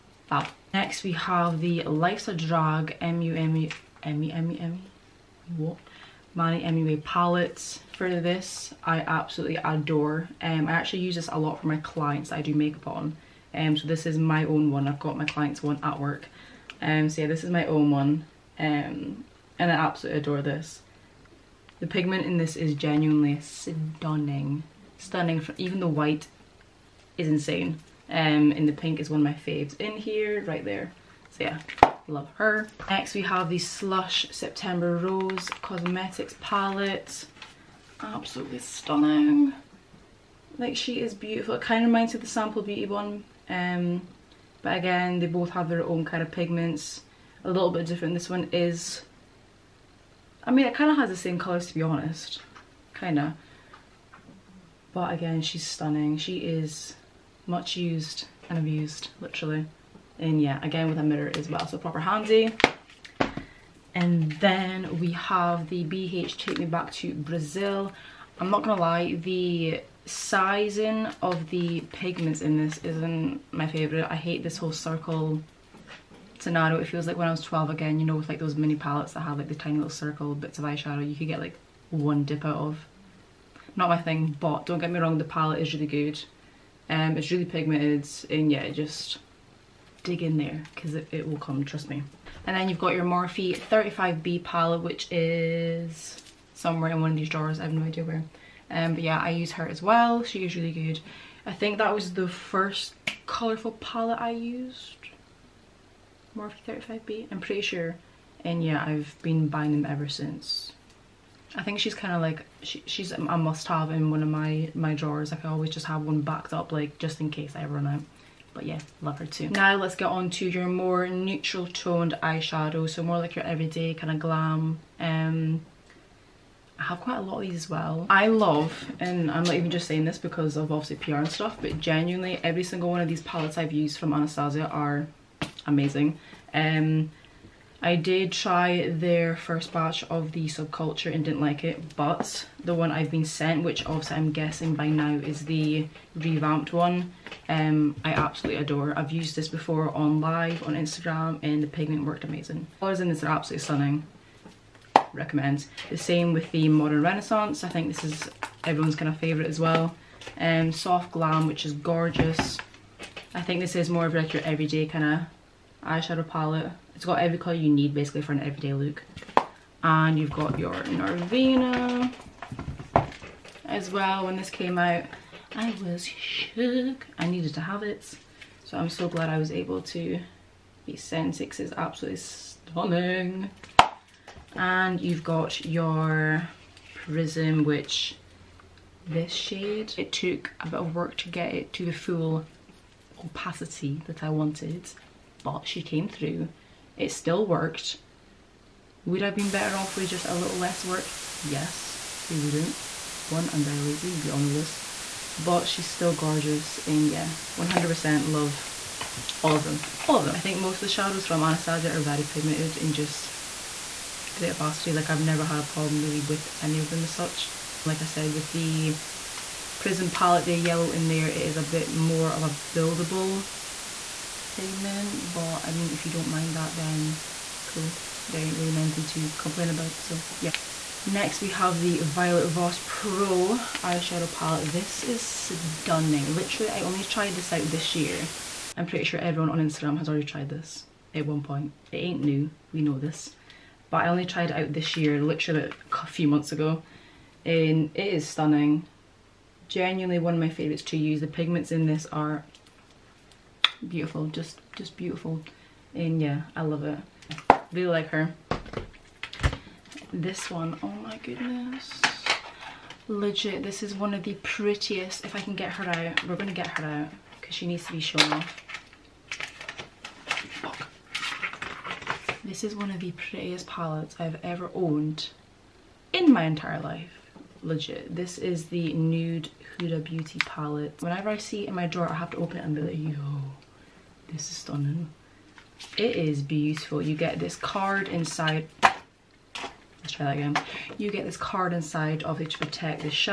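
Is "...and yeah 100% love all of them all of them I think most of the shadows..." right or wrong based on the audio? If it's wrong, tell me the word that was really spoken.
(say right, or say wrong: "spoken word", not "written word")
right.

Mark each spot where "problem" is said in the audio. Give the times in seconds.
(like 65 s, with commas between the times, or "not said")
215 s.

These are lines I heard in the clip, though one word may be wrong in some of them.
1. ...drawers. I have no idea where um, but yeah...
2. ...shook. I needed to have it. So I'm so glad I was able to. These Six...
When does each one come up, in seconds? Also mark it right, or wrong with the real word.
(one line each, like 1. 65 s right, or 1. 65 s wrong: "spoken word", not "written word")
1. 97 s right
2. 176 s right.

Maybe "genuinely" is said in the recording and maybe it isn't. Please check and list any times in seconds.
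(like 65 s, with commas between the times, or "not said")
22 s, 131 s, 249 s.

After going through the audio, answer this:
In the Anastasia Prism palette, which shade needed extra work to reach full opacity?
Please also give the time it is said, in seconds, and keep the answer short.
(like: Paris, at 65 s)
yellow, at 220 s.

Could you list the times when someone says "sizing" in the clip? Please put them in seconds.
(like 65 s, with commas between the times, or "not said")
70 s.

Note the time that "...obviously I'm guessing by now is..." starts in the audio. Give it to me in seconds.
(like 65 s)
143 s.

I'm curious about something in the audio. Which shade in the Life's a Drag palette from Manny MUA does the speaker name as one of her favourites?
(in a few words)
pink.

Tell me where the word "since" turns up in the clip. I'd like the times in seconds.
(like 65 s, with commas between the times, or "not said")
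110 s.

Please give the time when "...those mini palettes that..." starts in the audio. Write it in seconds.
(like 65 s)
78 s.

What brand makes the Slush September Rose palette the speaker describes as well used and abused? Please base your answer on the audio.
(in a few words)
Rose Cosmetics.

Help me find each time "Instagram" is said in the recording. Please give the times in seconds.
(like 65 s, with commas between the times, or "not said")
150 s, 239 s.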